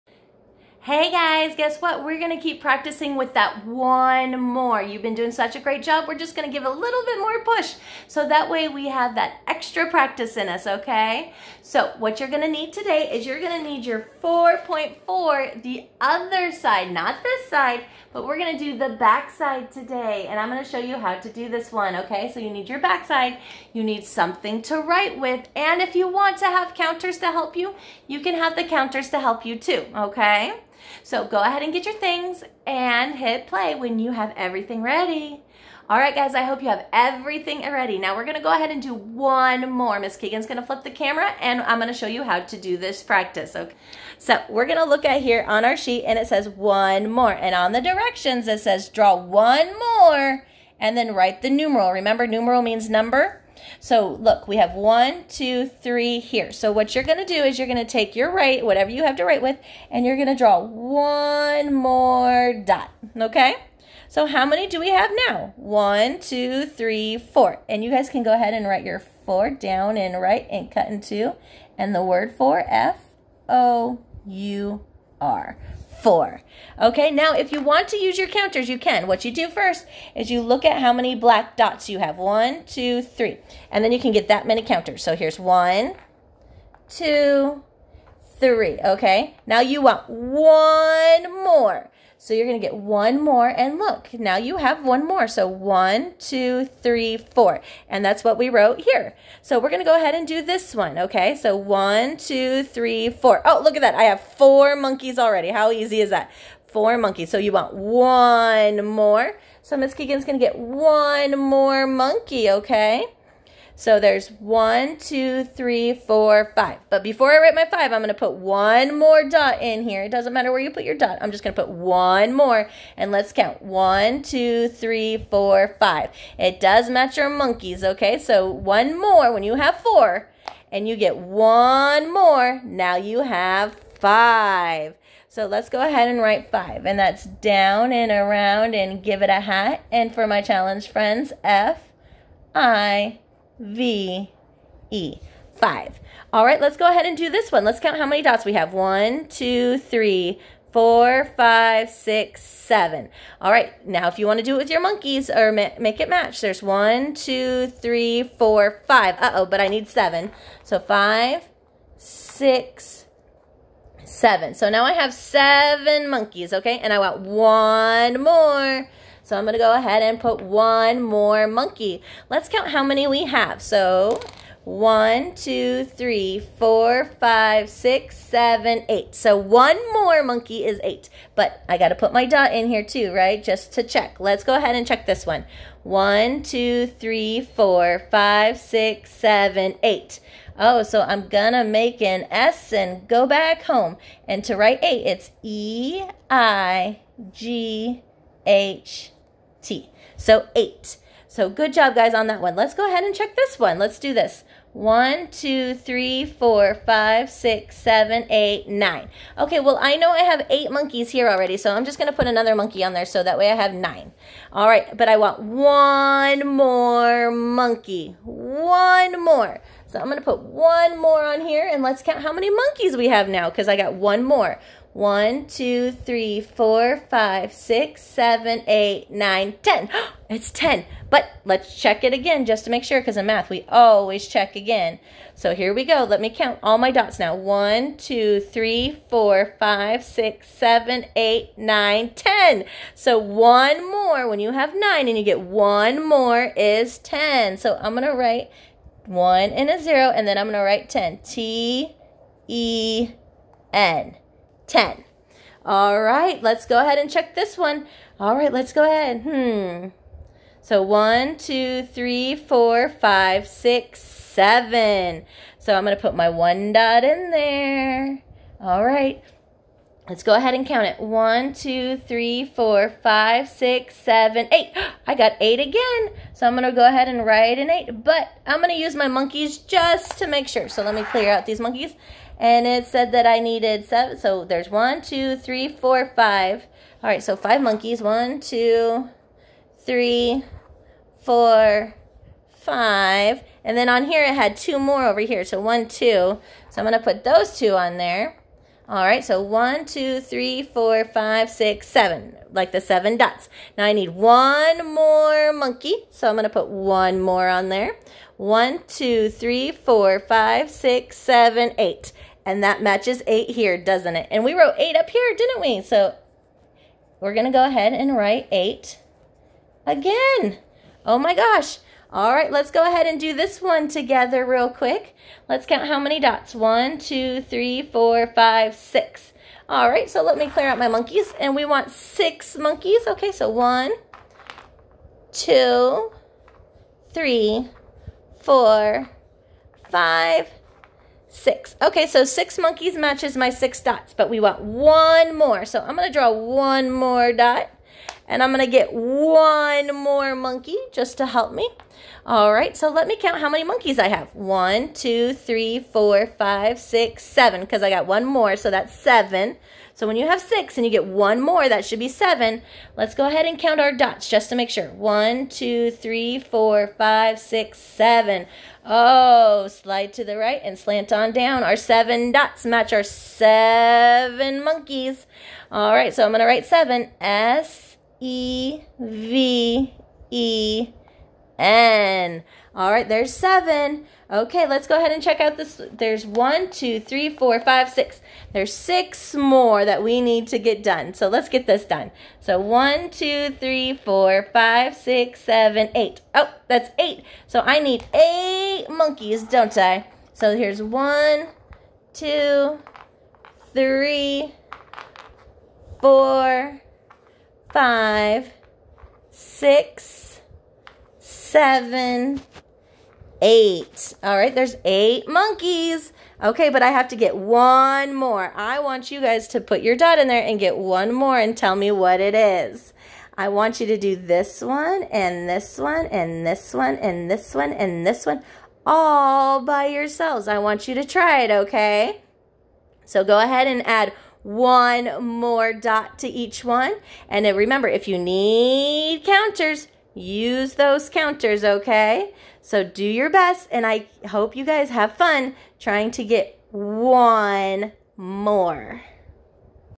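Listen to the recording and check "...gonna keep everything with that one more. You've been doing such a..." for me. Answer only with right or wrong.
wrong.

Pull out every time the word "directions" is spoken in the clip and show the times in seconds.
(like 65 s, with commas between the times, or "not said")
47 s.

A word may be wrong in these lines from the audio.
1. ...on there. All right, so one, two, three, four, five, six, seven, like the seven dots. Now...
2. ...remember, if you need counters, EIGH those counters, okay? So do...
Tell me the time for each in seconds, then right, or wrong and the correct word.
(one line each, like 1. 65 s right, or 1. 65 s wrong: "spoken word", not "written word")
1. 297 s right
2. 437 s wrong: "Use", not "EIGH".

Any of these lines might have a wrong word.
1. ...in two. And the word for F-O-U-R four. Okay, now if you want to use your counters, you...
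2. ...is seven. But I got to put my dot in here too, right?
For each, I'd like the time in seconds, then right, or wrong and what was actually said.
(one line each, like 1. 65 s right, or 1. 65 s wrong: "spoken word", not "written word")
1. 70 s right
2. 180 s wrong: "eight", not "seven".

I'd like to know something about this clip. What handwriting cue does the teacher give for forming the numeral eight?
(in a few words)
make an S and go back home.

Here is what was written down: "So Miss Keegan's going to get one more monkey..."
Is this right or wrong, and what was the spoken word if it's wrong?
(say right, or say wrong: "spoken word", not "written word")
right.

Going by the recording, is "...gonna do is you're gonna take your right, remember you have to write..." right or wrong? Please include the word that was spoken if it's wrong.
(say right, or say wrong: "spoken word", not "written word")
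wrong: "whatever", not "remember".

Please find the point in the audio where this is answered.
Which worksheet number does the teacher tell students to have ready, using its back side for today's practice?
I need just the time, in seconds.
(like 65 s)
14 s.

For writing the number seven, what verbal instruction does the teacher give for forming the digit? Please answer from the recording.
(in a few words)
slide to the right and slant on down.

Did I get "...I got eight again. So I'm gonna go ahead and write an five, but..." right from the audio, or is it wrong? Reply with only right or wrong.
wrong.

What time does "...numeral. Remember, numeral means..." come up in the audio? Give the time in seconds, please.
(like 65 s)
51 s.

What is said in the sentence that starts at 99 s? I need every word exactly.
So we're going to go ahead and do this one, okay?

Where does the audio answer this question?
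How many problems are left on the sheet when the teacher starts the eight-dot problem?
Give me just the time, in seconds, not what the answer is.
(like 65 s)
388 s.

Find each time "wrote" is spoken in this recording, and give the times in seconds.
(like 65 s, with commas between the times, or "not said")
98 s, 314 s.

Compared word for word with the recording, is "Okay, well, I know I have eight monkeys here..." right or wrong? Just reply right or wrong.
right.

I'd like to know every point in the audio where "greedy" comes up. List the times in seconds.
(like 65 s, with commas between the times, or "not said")
not said.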